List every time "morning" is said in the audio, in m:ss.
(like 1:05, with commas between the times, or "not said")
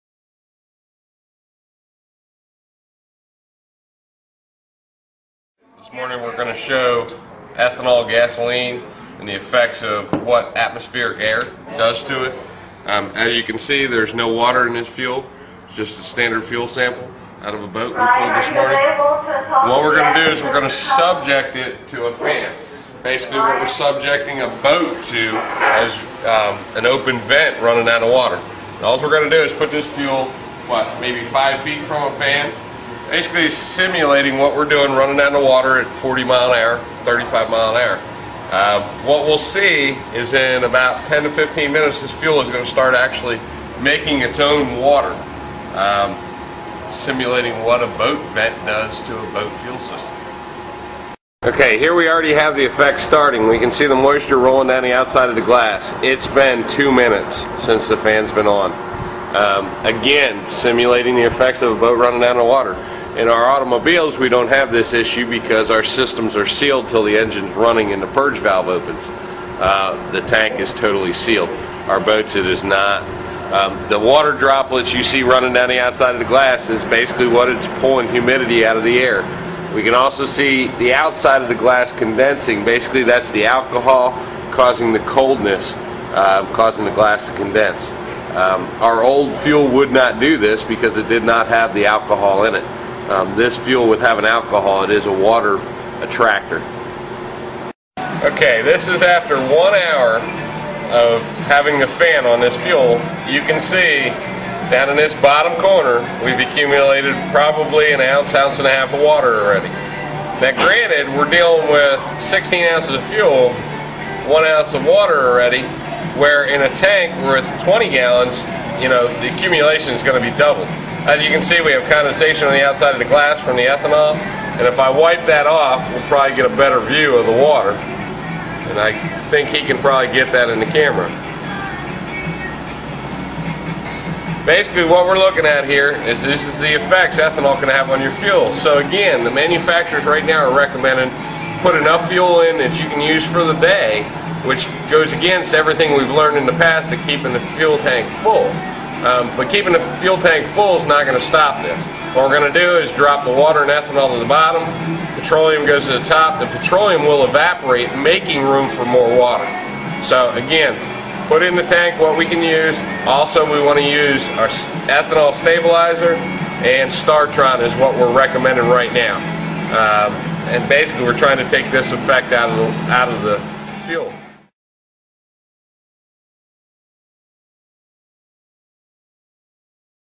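0:05, 0:18.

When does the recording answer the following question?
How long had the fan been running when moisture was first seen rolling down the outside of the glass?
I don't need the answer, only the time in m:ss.
0:56.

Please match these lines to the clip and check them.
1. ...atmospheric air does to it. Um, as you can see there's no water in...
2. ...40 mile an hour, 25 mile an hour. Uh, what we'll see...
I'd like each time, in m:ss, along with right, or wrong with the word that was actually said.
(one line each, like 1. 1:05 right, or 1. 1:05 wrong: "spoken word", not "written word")
1. 0:10 right
2. 0:35 wrong: "35", not "25".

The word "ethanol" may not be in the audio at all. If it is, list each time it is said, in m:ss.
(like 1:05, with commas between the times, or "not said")
0:07, 2:03, 2:17, 2:33, 2:44.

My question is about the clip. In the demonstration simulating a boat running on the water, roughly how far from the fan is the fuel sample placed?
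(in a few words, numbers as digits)
5 feet.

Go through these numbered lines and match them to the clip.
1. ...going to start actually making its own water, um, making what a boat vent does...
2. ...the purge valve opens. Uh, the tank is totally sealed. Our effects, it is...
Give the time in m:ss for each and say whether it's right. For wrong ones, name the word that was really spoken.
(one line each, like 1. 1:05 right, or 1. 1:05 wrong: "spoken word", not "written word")
1. 0:42 wrong: "simulating", not "making"
2. 1:08 wrong: "boats", not "effects".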